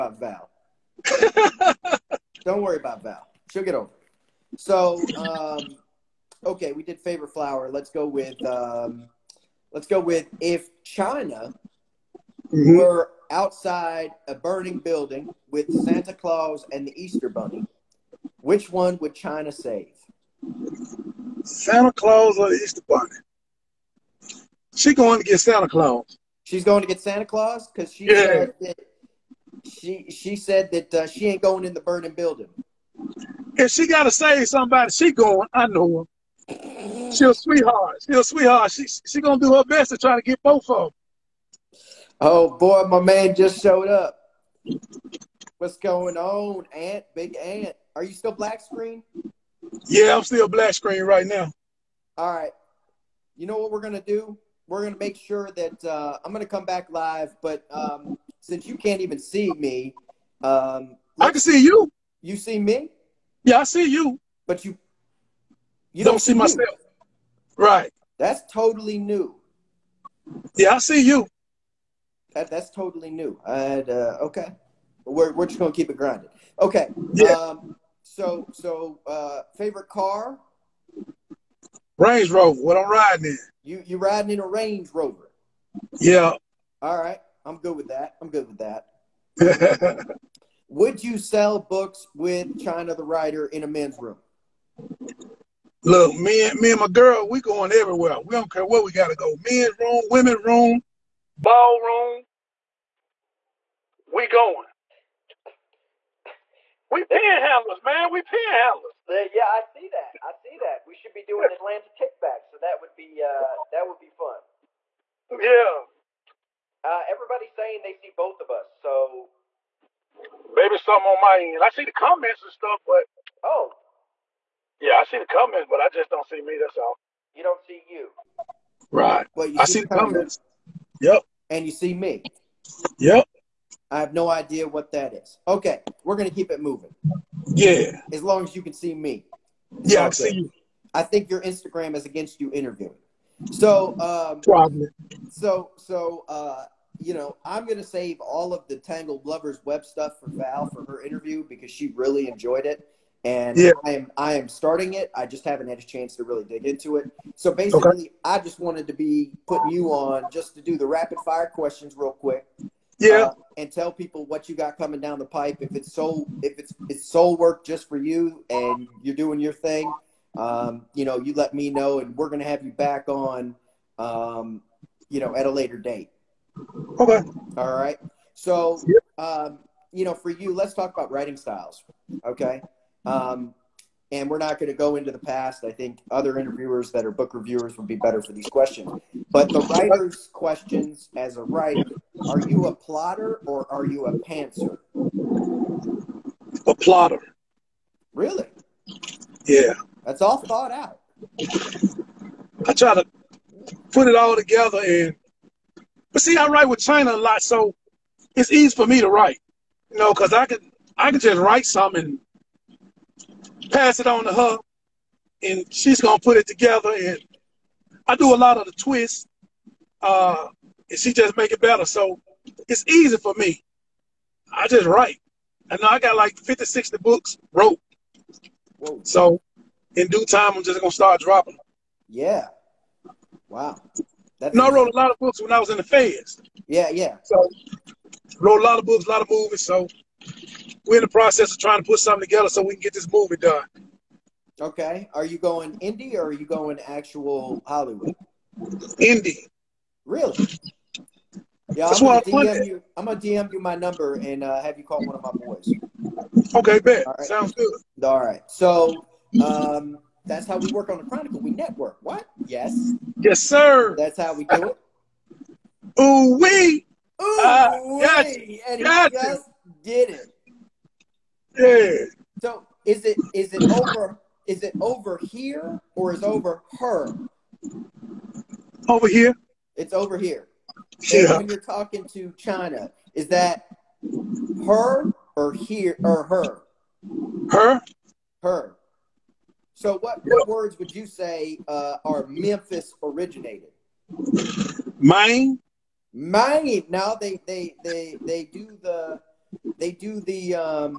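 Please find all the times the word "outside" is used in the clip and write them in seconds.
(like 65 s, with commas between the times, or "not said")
13 s.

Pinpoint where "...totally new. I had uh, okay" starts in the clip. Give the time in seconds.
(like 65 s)
72 s.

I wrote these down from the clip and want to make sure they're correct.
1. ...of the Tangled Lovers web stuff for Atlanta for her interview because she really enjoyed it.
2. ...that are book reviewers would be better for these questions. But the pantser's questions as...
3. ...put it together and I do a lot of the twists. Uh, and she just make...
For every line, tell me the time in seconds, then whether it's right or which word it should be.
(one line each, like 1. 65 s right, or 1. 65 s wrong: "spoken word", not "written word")
1. 148 s wrong: "Val", not "Atlanta"
2. 186 s wrong: "writer", not "pantser"
3. 216 s right.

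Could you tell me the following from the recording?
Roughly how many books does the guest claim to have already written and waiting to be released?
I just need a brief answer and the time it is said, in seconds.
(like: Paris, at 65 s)
50, 60, at 226 s.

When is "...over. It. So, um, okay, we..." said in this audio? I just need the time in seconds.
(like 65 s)
3 s.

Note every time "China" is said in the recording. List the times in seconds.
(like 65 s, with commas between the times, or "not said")
10 s, 19 s, 92 s, 206 s, 282 s.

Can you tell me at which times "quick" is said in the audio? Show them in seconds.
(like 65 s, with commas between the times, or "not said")
162 s.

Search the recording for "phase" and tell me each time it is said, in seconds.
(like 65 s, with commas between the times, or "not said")
not said.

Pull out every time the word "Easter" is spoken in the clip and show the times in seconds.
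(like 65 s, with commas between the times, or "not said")
17 s, 22 s.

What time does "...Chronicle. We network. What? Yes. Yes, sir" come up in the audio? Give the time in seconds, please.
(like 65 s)
261 s.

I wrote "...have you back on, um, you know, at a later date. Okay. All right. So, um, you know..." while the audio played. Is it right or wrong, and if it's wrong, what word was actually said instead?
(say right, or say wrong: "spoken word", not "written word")
right.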